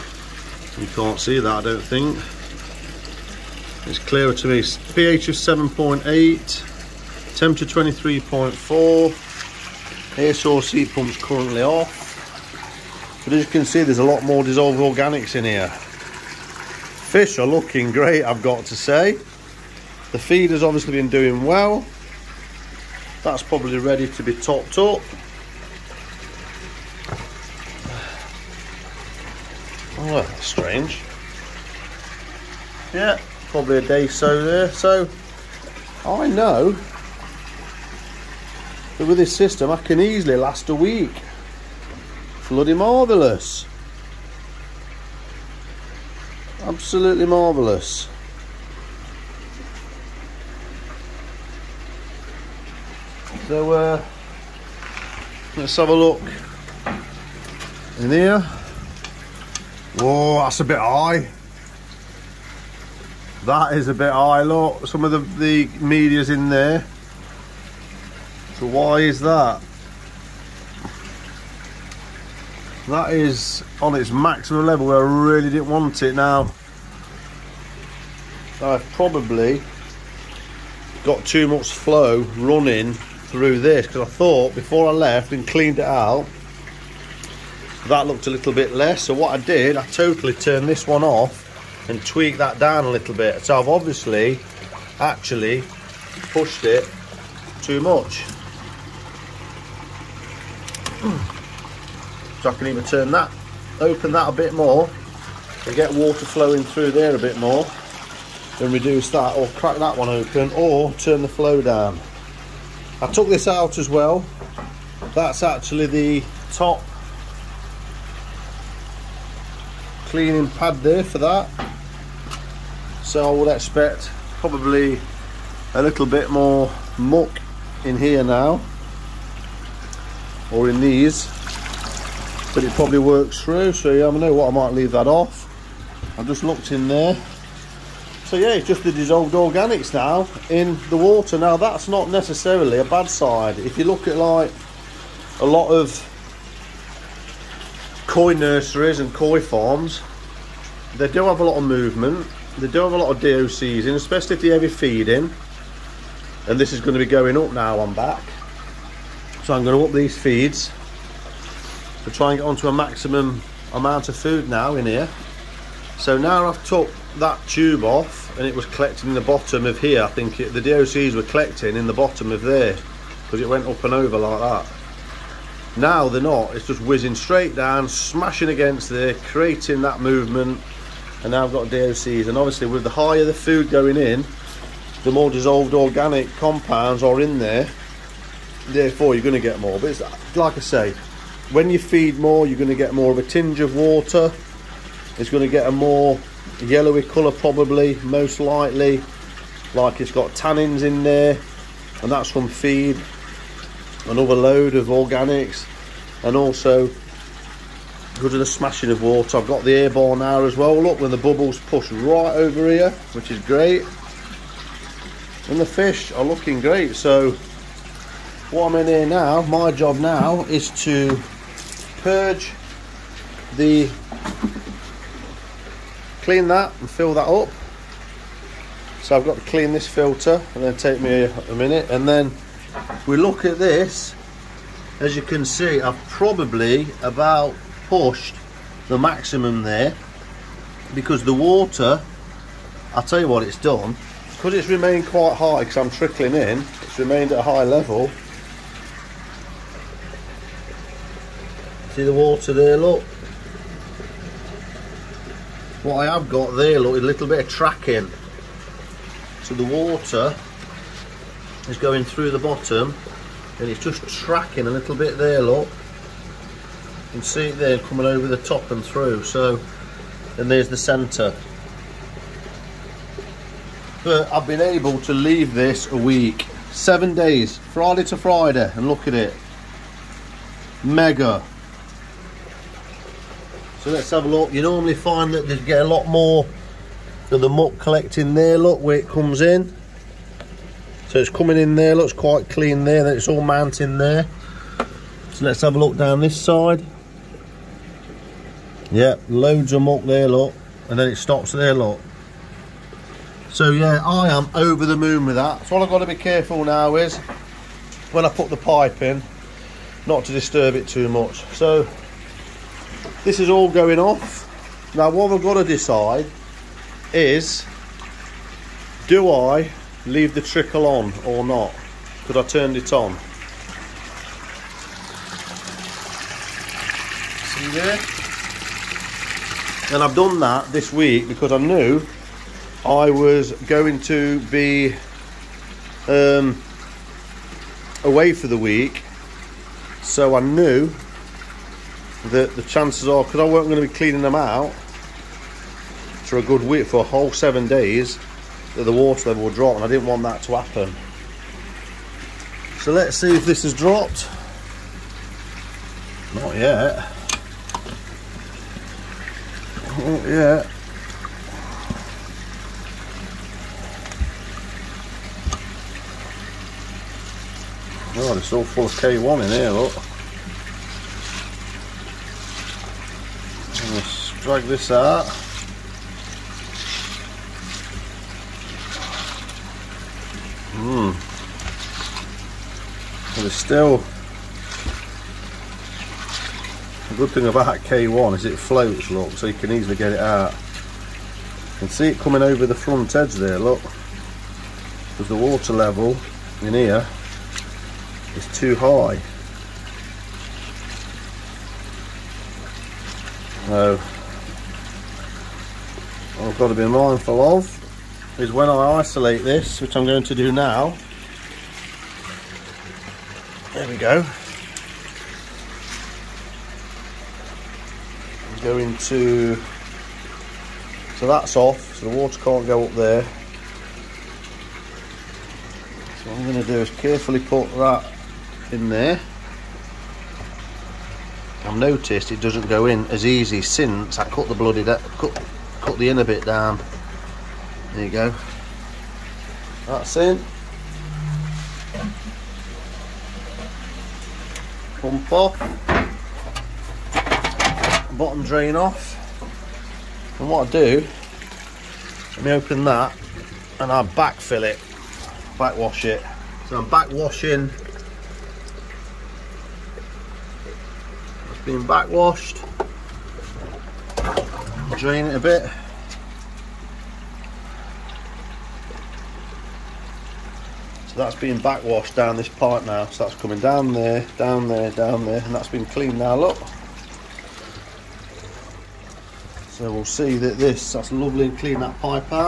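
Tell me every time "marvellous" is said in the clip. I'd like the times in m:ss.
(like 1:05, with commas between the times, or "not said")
0:42, 0:47.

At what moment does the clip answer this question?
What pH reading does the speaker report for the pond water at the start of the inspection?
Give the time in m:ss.
0:04.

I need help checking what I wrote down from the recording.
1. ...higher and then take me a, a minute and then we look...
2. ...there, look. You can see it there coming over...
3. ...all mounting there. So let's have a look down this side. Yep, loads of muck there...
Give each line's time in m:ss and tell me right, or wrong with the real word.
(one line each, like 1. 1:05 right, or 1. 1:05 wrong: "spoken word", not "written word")
1. 3:49 wrong: "filter", not "higher"
2. 4:25 right
3. 4:53 right.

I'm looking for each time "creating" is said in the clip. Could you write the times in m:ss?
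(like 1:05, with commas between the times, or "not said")
2:59.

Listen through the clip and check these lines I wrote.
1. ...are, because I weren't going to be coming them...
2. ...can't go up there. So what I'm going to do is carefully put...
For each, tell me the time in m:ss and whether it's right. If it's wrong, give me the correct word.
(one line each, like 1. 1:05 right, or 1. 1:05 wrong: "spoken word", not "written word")
1. 5:43 wrong: "cleaning", not "coming"
2. 7:02 right.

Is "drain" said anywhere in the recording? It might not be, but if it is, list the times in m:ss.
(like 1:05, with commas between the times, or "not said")
7:28, 7:44.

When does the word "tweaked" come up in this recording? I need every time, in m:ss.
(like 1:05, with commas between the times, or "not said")
1:32.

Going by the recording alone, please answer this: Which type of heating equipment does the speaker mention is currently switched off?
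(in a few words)
Air source heat pumps.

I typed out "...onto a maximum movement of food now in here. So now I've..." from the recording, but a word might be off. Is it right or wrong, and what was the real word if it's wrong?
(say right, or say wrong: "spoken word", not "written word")
wrong: "amount", not "movement".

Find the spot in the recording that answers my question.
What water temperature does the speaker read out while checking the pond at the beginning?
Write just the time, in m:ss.
0:07.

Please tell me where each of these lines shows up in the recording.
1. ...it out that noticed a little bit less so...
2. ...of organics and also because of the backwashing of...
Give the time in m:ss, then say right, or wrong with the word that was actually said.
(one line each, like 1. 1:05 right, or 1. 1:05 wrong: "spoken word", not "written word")
1. 1:25 wrong: "looked", not "noticed"
2. 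3:24 wrong: "smashing", not "backwashing".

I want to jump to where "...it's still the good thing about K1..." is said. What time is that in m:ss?
6:23.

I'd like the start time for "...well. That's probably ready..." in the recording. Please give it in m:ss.
0:21.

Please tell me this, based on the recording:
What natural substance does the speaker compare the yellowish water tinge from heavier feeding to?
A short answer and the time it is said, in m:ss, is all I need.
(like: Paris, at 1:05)
Tannins, at 3:20.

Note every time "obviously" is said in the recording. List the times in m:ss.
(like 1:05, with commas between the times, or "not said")
0:20, 1:33, 3:02.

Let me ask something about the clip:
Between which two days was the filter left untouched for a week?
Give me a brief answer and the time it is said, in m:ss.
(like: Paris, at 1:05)
Friday to Friday, at 4:37.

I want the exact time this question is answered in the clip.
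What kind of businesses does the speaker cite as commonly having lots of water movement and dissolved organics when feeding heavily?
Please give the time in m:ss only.
2:28.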